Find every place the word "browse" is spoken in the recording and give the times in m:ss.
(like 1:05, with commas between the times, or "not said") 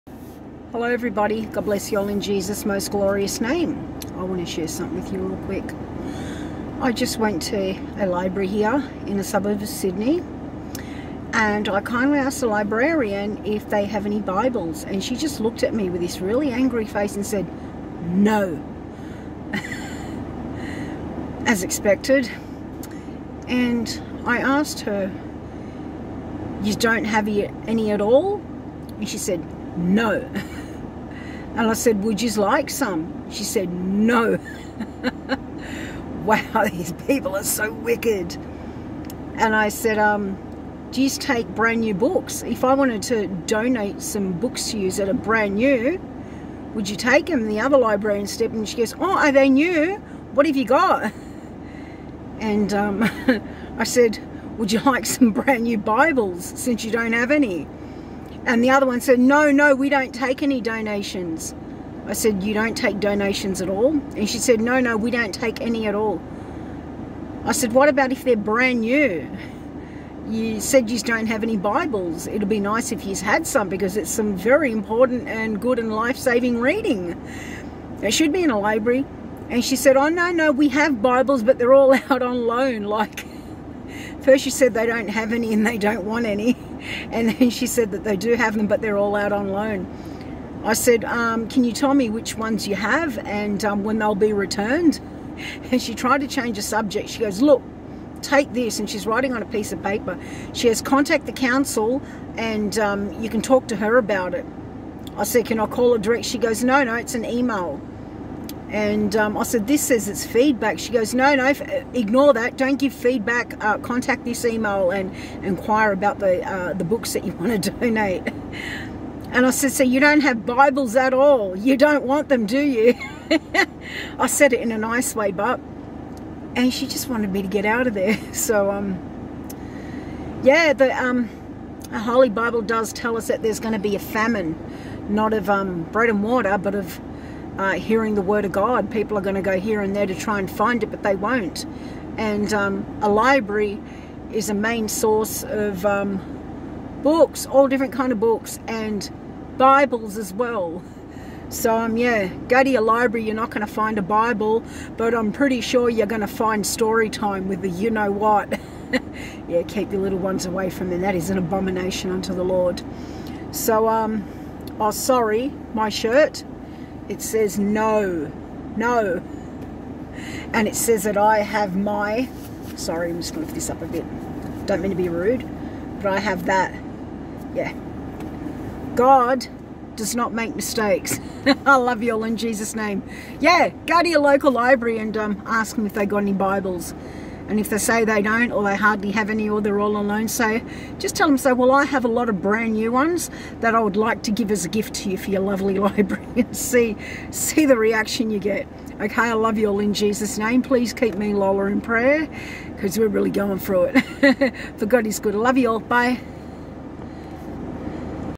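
not said.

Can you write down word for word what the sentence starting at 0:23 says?
And I asked her, you don't have any at all?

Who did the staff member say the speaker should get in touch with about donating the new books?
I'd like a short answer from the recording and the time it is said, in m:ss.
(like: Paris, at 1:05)
The council, at 1:41.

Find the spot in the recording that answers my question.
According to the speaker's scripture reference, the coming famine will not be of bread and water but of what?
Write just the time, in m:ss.
2:17.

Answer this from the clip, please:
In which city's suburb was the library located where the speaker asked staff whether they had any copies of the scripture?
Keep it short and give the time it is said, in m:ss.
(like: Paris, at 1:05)
Sydney, at 0:09.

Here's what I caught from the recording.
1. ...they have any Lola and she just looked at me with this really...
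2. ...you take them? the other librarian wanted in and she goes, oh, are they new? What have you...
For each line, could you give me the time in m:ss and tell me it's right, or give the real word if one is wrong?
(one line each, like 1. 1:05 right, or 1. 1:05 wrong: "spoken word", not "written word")
1. 0:13 wrong: "Bibles", not "Lola"
2. 0:46 wrong: "stepped", not "wanted".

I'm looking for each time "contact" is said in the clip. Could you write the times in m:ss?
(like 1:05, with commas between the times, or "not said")
1:40, 1:53.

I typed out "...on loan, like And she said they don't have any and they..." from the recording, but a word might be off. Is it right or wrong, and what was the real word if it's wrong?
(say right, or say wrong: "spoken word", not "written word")
wrong: "First", not "And".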